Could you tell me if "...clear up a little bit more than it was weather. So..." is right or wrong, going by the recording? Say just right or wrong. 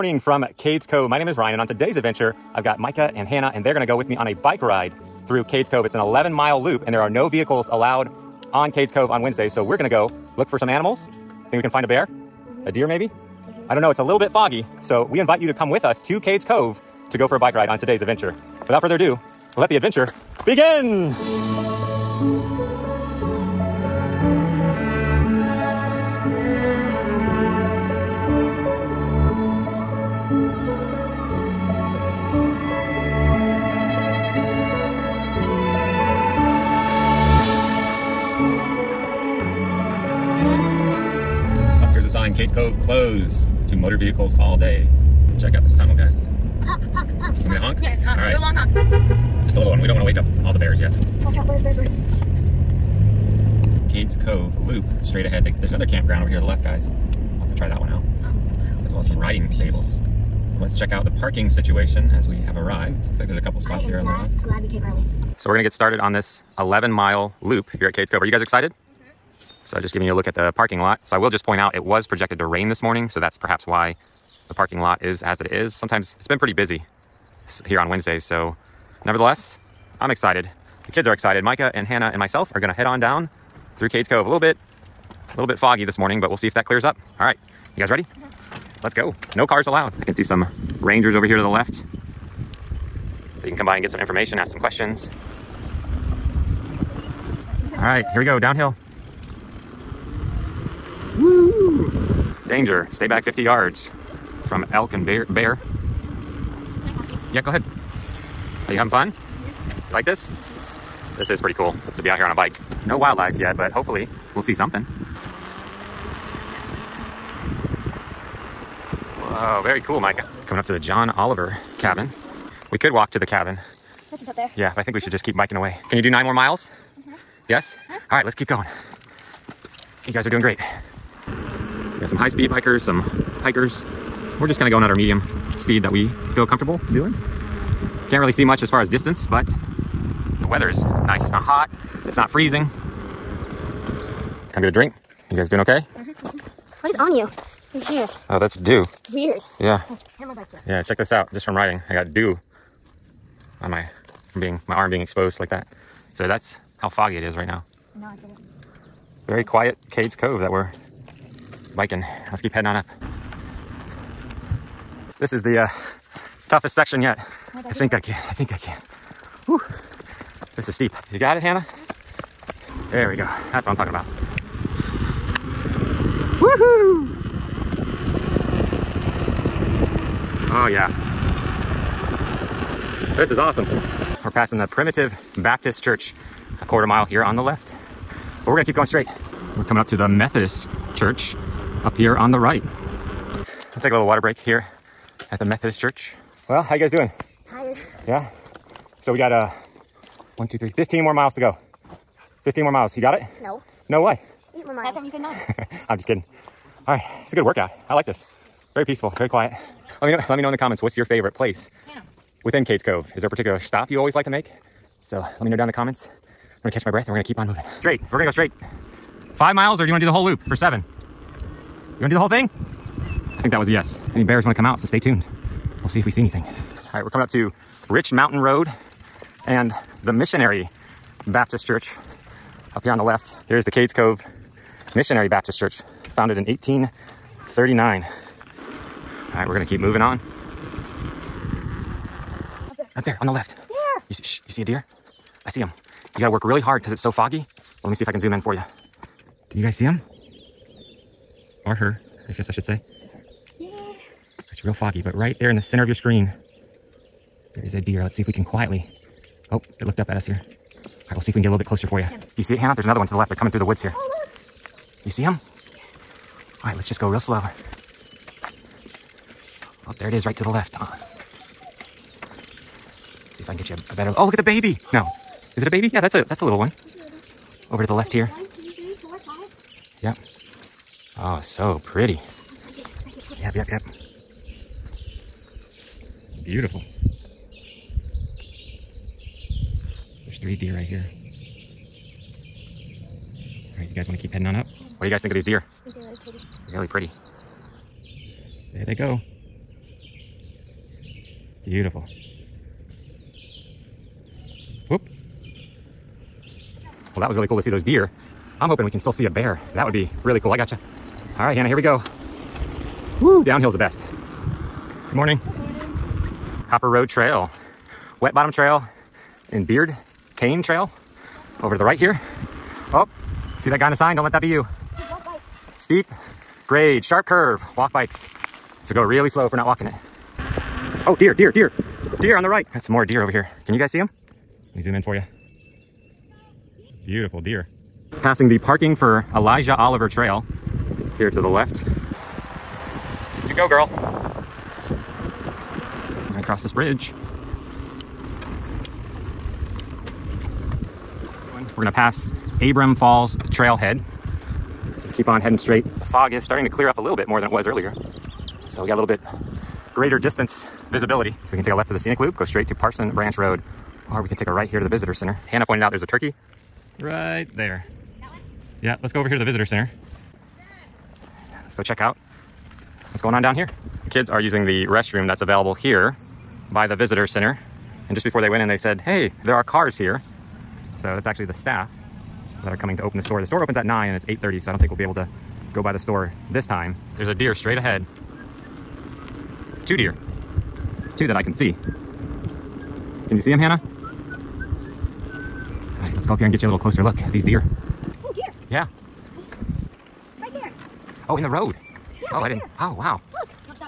wrong.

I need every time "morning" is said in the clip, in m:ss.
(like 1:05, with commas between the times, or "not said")
1:12, 1:25, 5:15.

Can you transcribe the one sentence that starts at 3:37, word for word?
Straight, so we're gonna go straight.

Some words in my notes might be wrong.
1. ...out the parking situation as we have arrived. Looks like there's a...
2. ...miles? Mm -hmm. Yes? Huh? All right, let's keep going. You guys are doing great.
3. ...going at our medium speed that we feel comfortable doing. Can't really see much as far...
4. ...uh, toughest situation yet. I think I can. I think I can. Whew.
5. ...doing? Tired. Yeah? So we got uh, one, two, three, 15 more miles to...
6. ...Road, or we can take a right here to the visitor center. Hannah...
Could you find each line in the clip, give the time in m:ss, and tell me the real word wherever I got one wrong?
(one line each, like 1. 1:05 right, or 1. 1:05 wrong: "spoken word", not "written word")
1. 1:00 right
2. 2:06 right
3. 2:14 right
4. 2:45 wrong: "section", not "situation"
5. 3:16 right
6. 6:03 right.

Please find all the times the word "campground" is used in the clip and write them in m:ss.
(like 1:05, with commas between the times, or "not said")
0:55.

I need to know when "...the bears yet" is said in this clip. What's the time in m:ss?
0:50.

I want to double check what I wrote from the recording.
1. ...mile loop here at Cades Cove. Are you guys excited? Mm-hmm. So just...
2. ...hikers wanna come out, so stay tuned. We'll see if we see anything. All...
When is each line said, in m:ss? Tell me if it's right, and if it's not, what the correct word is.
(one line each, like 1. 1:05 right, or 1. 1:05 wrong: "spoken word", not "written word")
1. 1:06 right
2. 3:44 wrong: "bears", not "hikers".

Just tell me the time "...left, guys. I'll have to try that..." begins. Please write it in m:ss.
0:56.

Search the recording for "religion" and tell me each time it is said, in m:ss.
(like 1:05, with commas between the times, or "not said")
not said.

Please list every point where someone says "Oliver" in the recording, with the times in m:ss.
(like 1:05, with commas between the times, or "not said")
2:01, 5:39.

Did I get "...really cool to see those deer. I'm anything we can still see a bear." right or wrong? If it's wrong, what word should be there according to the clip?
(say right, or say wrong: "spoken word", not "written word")
wrong: "hoping", not "anything".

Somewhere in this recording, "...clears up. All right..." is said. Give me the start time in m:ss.
1:26.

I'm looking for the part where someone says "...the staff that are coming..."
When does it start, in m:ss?
6:21.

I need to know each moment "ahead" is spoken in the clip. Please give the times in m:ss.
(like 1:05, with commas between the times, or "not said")
0:55, 1:47, 6:27.